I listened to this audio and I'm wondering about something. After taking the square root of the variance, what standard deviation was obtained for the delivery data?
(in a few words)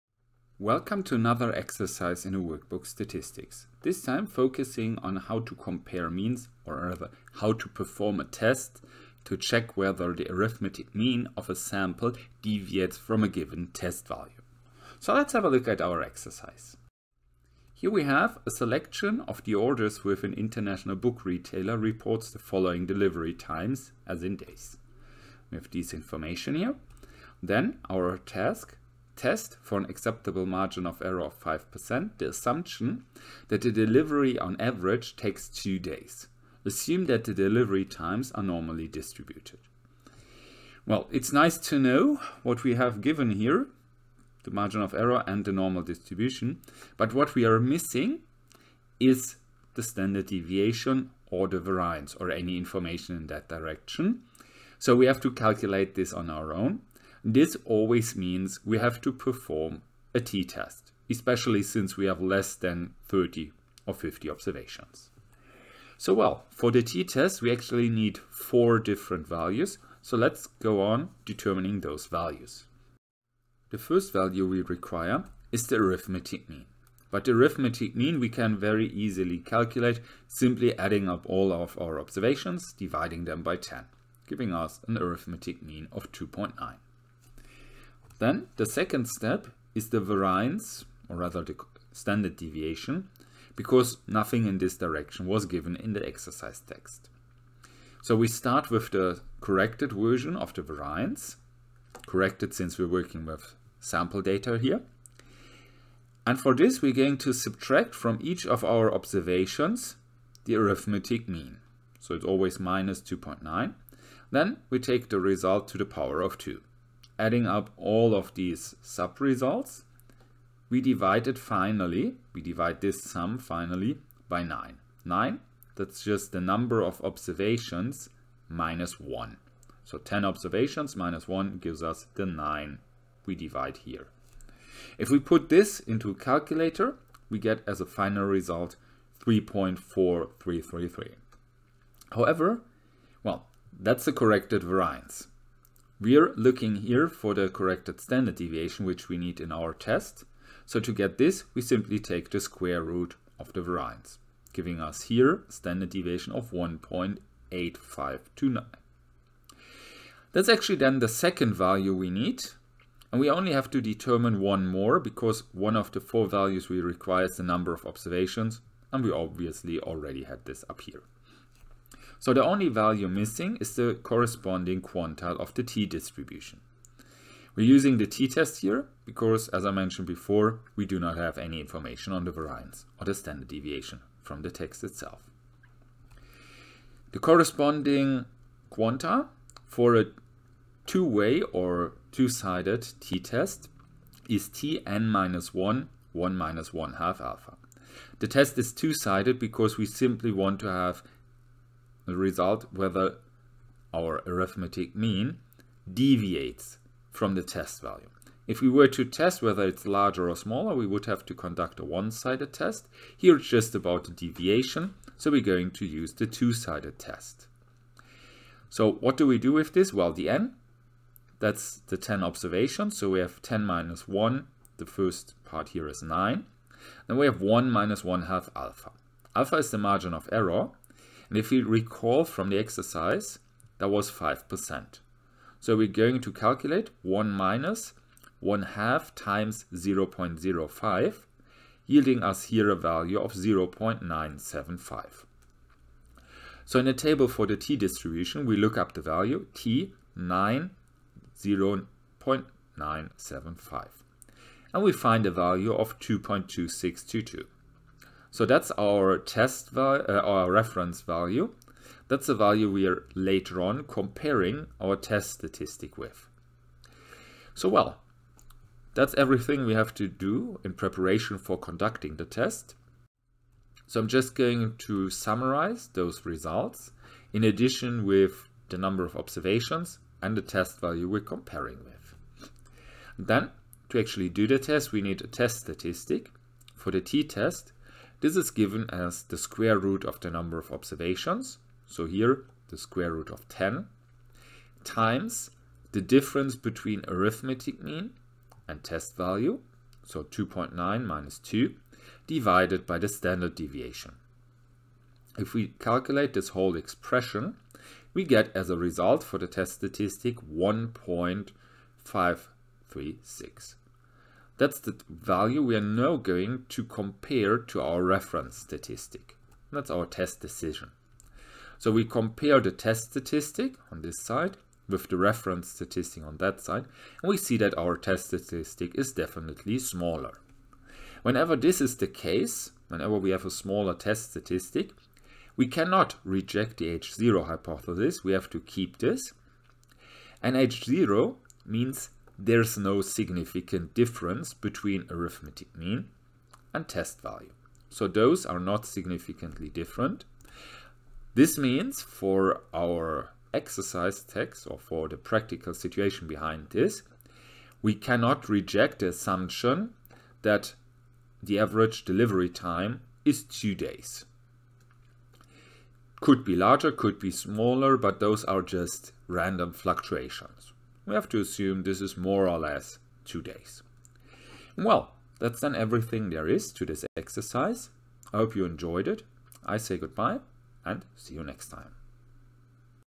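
1.8529.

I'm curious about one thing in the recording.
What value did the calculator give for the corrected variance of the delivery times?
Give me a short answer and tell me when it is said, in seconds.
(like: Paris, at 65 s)
3.4333, at 139 s.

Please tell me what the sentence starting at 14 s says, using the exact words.
So let's have a look at our exercise.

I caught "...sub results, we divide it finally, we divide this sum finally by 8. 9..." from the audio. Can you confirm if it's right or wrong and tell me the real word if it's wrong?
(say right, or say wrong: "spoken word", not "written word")
wrong: "9", not "8".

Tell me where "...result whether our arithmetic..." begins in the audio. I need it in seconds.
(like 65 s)
202 s.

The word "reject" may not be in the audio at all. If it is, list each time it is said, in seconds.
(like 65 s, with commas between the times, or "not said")
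336 s, 358 s.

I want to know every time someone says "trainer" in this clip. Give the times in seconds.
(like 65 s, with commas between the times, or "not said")
not said.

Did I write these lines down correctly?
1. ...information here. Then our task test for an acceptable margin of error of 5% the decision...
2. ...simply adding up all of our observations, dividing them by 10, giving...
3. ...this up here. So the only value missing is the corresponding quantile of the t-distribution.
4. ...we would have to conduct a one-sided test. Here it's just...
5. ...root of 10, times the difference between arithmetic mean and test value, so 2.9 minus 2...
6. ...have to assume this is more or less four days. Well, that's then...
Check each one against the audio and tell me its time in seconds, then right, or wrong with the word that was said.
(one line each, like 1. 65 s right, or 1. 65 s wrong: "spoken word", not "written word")
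1. 25 s wrong: "assumption", not "decision"
2. 80 s right
3. 170 s right
4. 210 s right
5. 293 s right
6. 371 s wrong: "two", not "four".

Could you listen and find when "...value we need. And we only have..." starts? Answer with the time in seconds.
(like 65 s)
161 s.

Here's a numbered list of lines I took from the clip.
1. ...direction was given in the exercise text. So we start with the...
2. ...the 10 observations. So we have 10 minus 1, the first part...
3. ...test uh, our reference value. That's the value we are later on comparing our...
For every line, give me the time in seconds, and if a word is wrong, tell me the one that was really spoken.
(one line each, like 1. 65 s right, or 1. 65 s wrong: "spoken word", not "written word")
1. 94 s right
2. 221 s right
3. 259 s right.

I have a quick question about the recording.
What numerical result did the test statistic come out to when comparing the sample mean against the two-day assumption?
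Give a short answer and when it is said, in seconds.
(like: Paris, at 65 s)
1.536, at 310 s.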